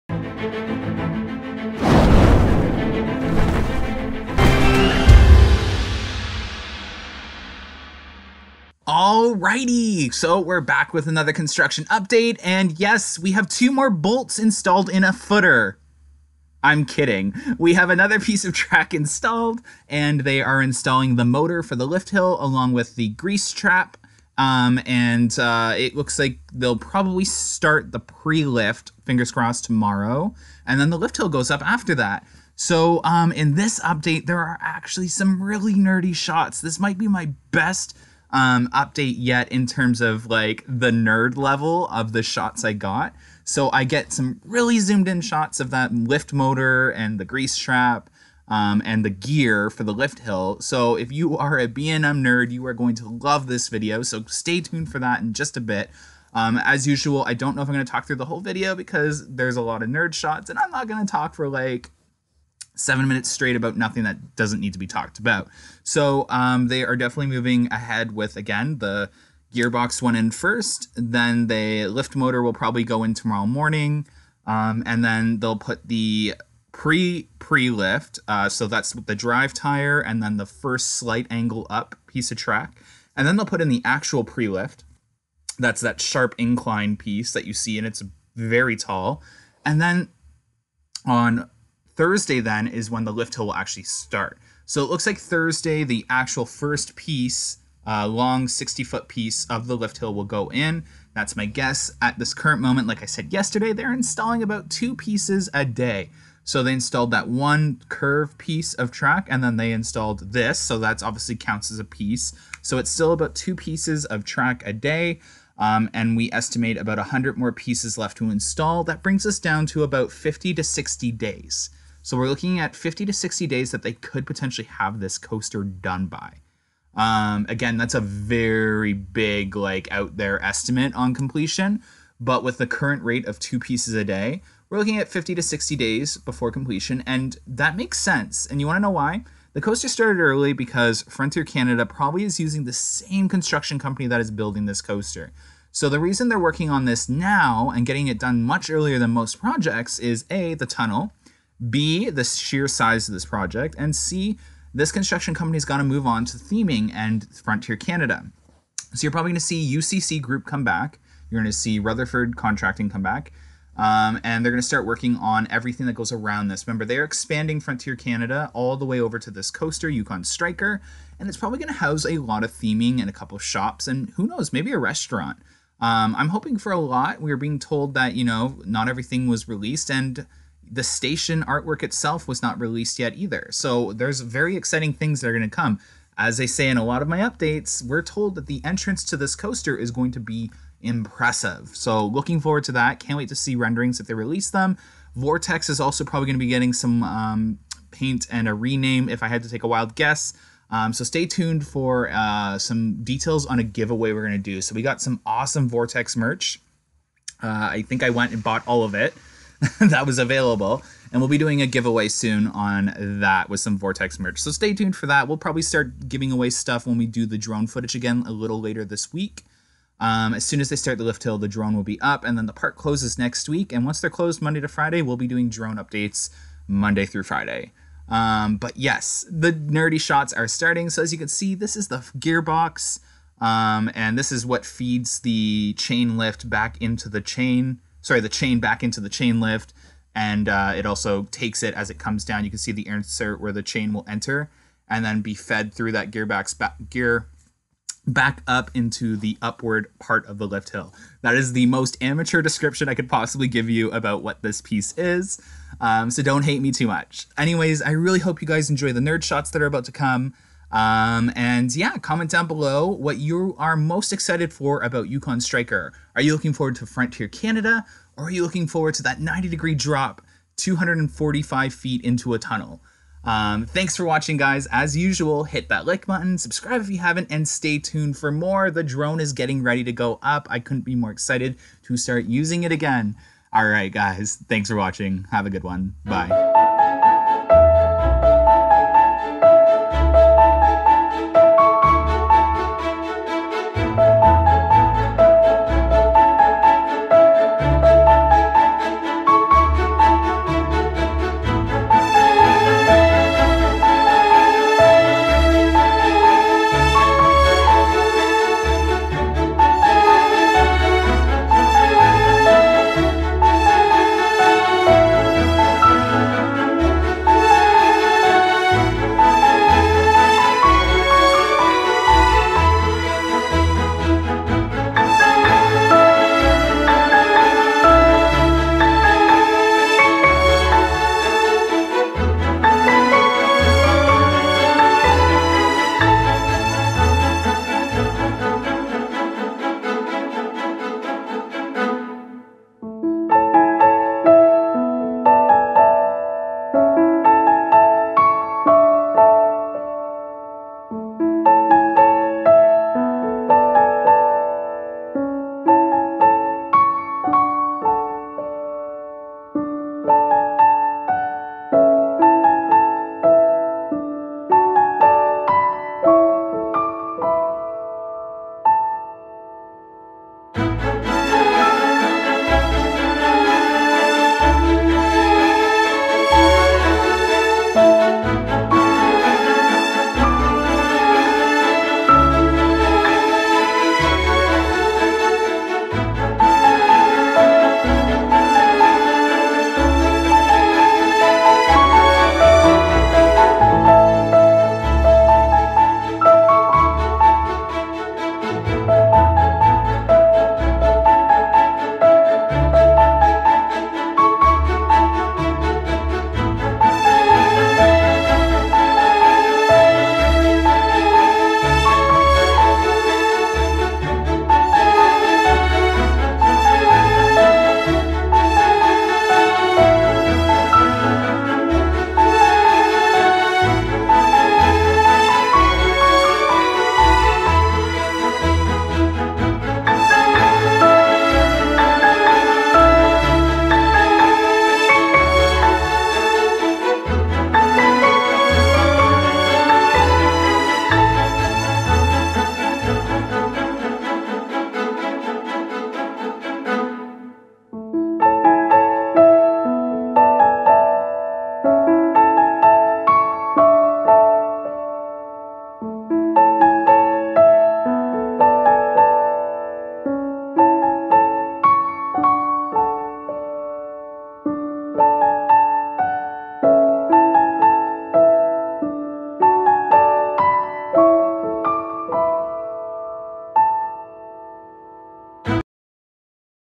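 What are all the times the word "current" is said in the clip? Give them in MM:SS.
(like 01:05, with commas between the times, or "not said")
01:42, 02:12.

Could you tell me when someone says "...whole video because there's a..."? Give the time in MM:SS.
00:58.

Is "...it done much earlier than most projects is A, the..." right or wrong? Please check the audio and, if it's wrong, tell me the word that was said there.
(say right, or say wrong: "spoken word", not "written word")
right.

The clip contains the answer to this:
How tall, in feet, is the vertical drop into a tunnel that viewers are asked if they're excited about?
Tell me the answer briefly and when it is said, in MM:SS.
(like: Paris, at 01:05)
245, at 04:30.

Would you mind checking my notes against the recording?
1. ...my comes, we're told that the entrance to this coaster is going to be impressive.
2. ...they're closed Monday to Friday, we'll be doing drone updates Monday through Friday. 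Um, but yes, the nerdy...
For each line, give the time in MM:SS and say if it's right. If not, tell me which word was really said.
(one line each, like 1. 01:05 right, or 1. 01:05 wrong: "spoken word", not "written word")
1. 03:07 wrong: "updates", not "comes"
2. 03:44 right.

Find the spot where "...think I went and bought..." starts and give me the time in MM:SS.
03:27.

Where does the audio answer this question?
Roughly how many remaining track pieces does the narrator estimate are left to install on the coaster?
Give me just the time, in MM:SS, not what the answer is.
01:56.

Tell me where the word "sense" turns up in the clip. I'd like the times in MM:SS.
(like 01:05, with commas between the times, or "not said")
02:17.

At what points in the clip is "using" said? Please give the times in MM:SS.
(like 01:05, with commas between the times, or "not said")
02:22, 04:42.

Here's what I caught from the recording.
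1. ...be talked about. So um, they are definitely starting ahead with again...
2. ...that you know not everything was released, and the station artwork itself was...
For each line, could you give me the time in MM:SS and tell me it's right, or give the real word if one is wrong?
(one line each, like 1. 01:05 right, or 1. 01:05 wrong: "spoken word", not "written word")
1. 01:04 wrong: "moving", not "starting"
2. 02:57 right.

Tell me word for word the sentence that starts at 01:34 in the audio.
So it looks like Thursday, the actual first piece, uh, long 60 foot piece of the lift hill will go in.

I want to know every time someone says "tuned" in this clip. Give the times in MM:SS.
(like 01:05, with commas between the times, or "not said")
00:54, 03:21, 03:34, 04:37.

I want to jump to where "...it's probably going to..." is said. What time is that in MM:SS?
02:51.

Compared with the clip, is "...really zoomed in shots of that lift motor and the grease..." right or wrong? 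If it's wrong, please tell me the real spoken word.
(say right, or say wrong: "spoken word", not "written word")
right.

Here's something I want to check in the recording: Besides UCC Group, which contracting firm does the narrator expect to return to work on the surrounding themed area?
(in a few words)
Rutherford Contracting.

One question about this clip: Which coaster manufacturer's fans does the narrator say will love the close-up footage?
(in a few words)
B&M.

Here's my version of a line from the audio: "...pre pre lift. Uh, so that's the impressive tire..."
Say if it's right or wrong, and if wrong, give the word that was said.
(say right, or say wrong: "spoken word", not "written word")
wrong: "drive", not "impressive".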